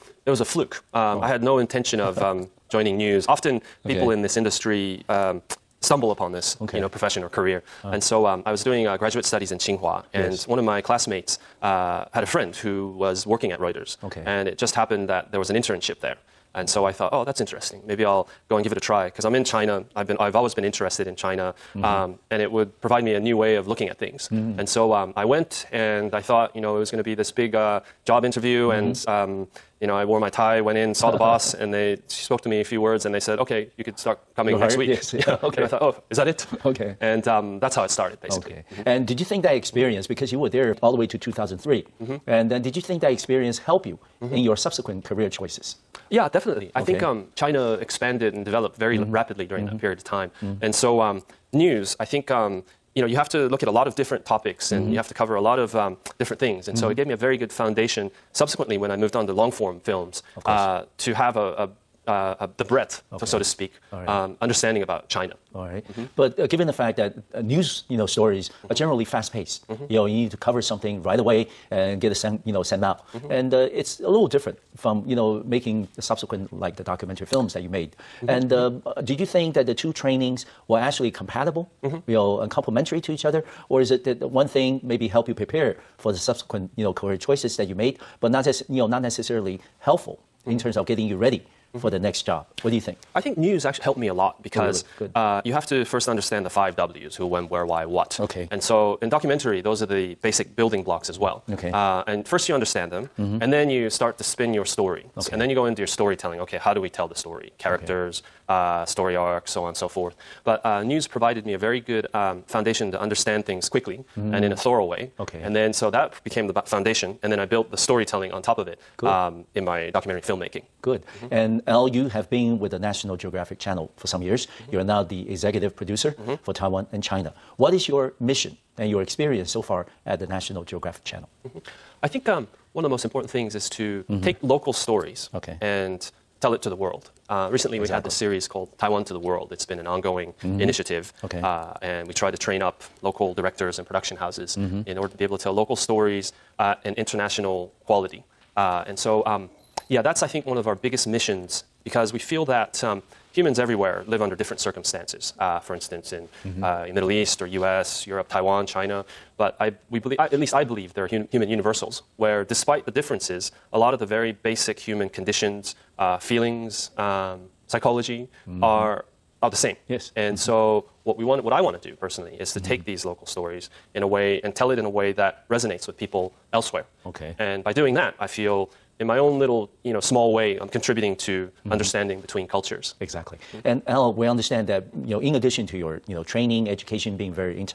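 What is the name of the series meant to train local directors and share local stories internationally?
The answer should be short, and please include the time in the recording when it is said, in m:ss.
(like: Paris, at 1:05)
Taiwan to the World, at 2:18.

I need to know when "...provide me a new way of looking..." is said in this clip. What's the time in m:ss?
0:22.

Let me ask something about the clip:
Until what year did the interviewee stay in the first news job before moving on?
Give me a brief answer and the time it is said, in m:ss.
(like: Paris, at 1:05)
2003, at 0:41.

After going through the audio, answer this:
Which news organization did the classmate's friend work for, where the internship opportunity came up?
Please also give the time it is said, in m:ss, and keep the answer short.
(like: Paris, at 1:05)
Reuters, at 0:13.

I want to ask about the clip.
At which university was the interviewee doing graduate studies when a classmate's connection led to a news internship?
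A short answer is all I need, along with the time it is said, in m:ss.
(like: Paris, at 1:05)
Tsinghua, at 0:09.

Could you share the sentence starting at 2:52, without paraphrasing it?
take these local stories in a way and tell it in a way that resonates with people elsewhere.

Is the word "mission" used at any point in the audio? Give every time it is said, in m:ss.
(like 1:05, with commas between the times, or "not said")
2:08, 2:31.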